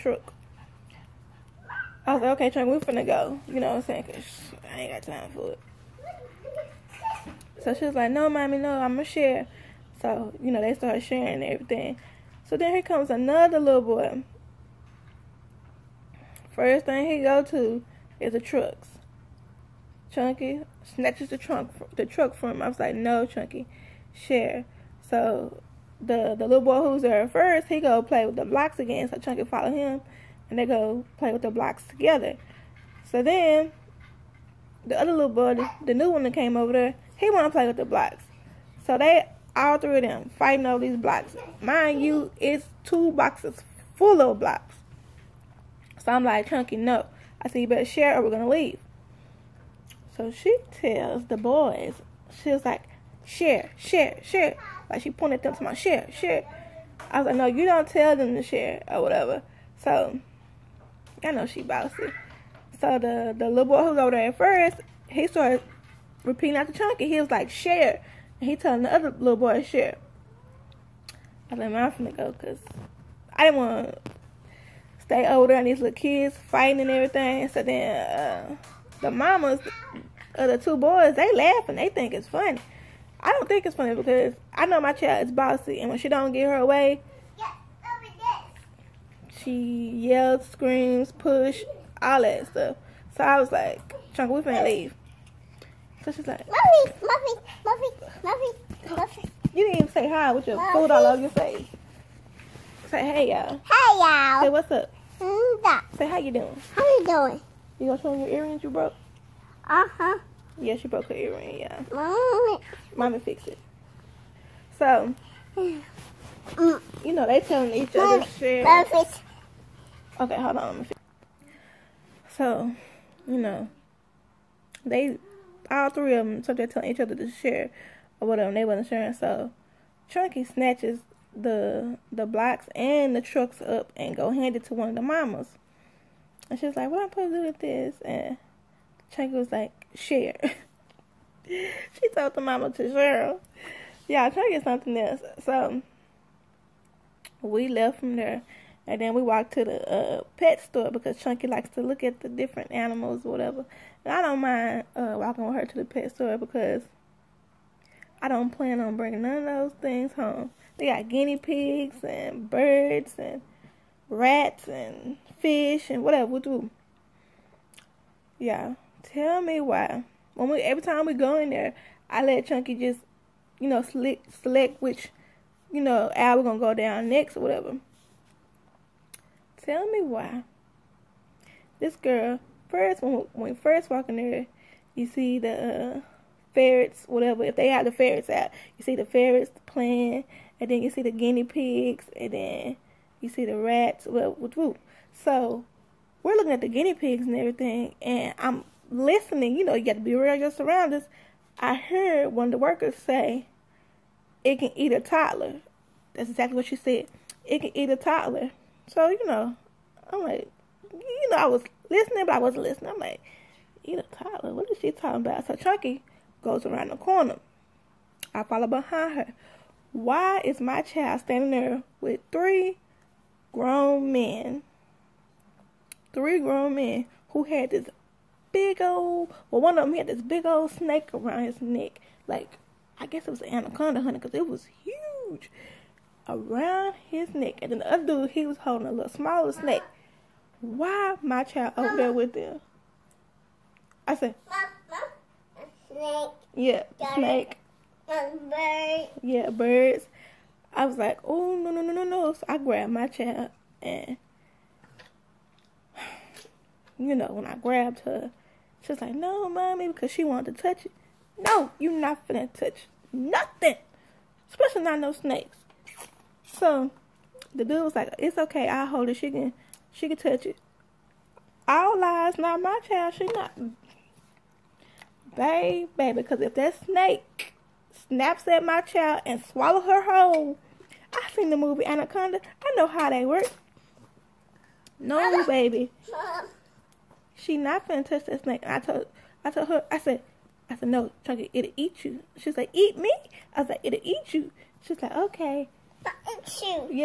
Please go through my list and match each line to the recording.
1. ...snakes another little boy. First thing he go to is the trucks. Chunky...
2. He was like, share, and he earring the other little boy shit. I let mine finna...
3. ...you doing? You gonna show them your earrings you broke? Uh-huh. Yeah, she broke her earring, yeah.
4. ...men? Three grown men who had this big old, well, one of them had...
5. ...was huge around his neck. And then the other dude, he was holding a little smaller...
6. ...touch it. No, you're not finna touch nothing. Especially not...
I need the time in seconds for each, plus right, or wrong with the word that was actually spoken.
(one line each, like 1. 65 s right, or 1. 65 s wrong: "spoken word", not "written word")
1. 12 s wrong: "comes", not "snakes"
2. 67 s wrong: "telling", not "earring"
3. 106 s right
4. 224 s right
5. 234 s right
6. 260 s right.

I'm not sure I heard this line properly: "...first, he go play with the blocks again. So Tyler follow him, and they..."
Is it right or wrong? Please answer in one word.
wrong.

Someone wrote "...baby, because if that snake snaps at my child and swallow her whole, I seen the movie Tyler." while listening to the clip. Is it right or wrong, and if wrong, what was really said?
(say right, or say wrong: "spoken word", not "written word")
wrong: "Anaconda", not "Tyler".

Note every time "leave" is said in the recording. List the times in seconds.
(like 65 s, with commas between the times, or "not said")
48 s, 94 s.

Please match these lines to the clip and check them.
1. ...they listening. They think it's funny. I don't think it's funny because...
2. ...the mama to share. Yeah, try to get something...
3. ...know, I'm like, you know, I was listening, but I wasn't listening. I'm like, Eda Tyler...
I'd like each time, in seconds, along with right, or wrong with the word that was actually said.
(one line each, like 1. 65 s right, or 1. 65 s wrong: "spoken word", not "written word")
1. 81 s wrong: "laughing", not "listening"
2. 142 s right
3. 209 s right.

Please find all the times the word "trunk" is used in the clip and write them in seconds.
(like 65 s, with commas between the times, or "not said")
21 s.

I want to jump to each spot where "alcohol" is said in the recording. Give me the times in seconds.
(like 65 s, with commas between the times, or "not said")
not said.